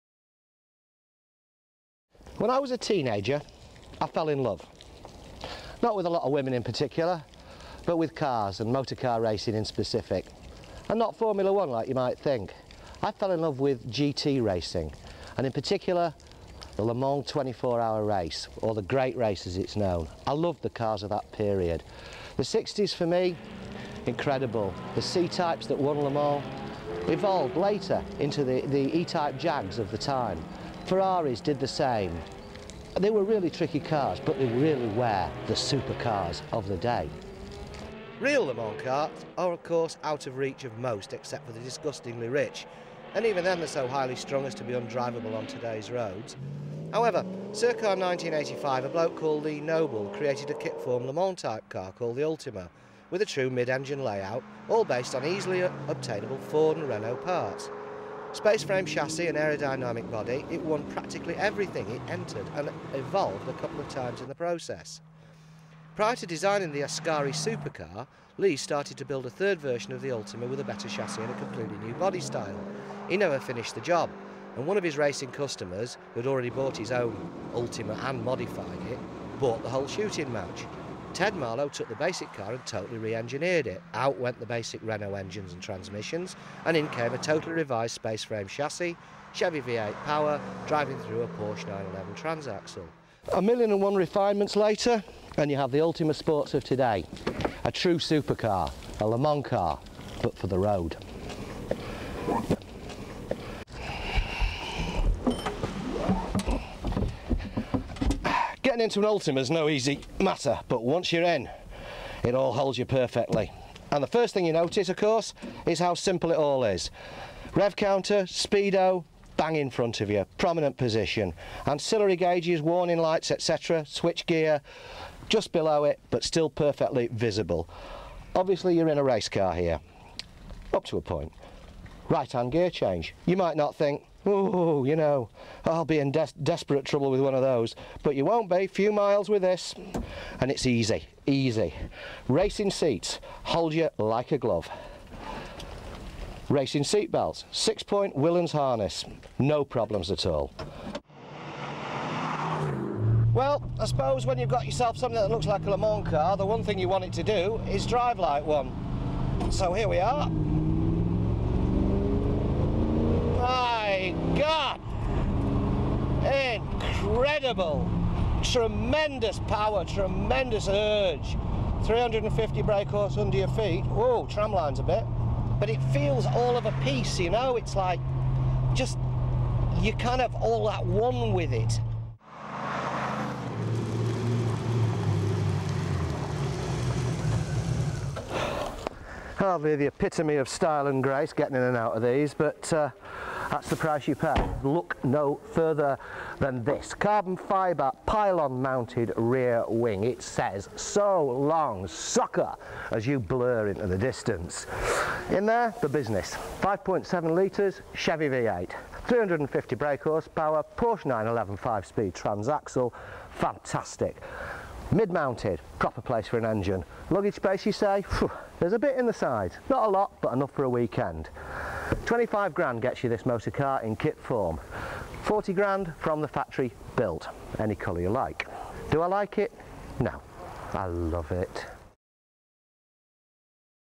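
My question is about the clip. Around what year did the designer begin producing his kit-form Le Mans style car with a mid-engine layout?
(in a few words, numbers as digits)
1985.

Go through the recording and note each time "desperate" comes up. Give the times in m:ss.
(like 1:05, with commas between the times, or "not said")
2:16.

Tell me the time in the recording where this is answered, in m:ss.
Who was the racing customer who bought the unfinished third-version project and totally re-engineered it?
1:21.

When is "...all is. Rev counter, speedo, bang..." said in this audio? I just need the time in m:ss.
1:56.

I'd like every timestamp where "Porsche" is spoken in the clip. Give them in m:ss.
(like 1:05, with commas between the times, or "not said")
1:31, 3:30.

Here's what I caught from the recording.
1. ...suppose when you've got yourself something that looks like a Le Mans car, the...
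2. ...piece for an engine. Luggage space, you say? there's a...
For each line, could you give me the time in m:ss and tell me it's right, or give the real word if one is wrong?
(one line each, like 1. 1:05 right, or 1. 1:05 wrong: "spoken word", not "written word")
1. 2:33 right
2. 3:35 wrong: "place", not "piece".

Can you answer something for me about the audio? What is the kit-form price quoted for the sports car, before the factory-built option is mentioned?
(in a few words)
25 grand.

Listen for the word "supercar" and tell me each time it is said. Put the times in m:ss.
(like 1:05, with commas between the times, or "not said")
0:35, 1:07, 1:37.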